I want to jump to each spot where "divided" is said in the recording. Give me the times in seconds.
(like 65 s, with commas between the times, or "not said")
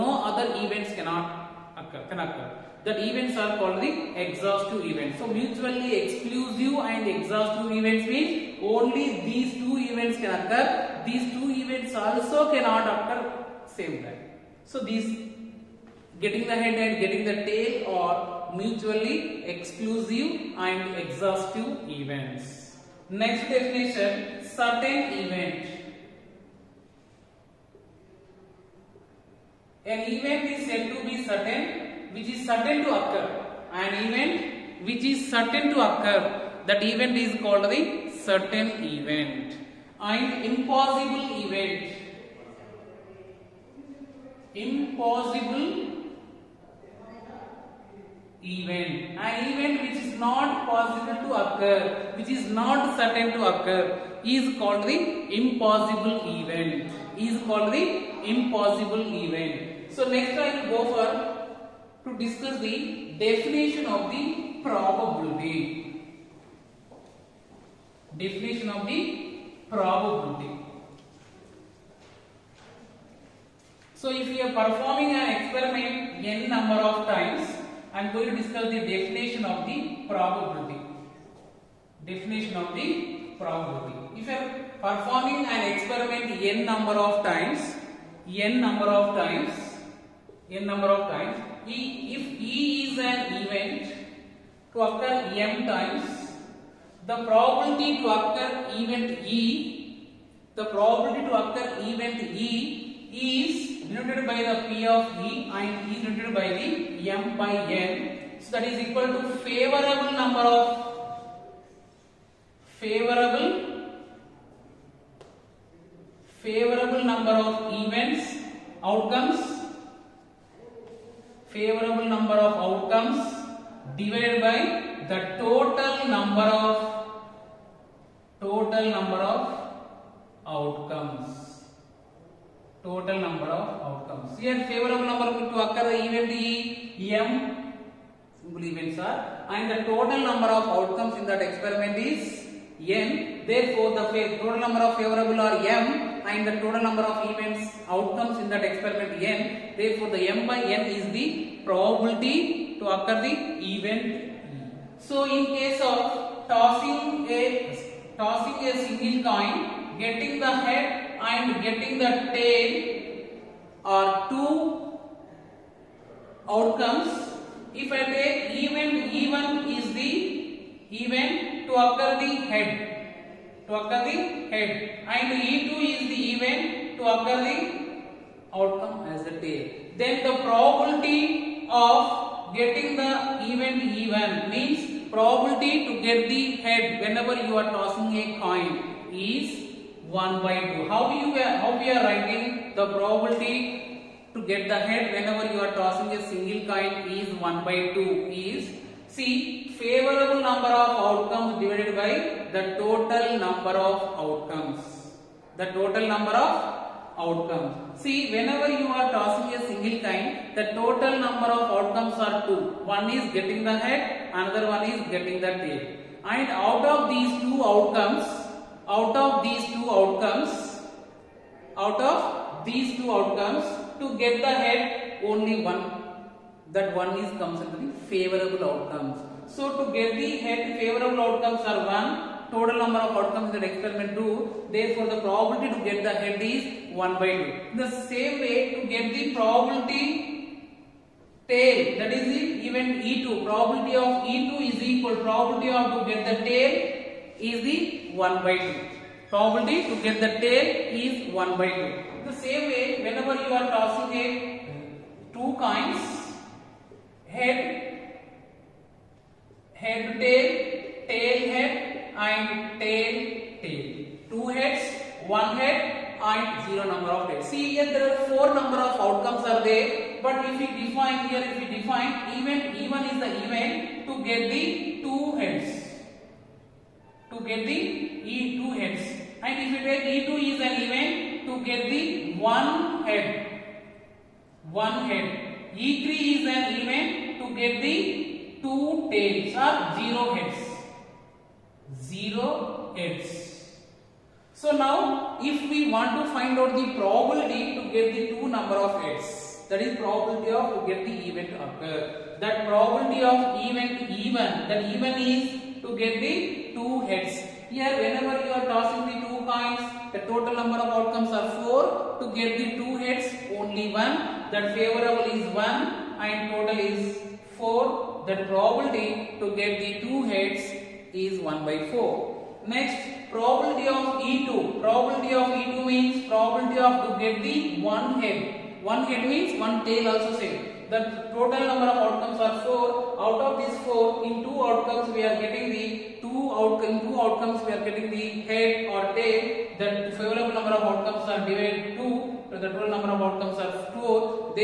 123 s, 201 s, 341 s.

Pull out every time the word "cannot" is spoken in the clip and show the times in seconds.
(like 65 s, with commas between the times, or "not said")
0 s, 12 s.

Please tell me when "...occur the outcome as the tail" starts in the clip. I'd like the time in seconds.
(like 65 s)
177 s.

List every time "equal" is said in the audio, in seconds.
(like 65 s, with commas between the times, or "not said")
108 s, 244 s.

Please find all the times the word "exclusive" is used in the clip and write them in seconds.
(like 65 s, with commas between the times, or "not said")
5 s, 19 s.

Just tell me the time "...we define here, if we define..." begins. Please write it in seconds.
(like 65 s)
270 s.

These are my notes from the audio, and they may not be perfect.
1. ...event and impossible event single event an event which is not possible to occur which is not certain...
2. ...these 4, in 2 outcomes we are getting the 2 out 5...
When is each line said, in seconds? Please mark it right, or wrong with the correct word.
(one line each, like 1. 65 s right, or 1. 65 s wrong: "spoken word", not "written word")
1. 38 s wrong: "impossible", not "single"
2. 333 s wrong: "2", not "5".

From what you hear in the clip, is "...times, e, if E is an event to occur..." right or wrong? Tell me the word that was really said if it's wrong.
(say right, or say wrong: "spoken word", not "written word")
right.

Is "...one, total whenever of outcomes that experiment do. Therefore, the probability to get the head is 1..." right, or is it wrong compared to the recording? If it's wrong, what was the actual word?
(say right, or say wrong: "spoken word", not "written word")
wrong: "number", not "whenever".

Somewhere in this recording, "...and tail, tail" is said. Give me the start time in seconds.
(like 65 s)
262 s.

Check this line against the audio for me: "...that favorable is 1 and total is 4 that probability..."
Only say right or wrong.
right.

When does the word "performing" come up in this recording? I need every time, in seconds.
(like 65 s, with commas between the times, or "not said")
74 s, 84 s.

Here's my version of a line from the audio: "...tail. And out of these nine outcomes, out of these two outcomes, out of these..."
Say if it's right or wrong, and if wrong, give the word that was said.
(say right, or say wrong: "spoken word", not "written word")
wrong: "two", not "nine".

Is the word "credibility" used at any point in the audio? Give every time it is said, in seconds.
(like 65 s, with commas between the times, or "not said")
not said.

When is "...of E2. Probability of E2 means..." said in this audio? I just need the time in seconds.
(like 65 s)
323 s.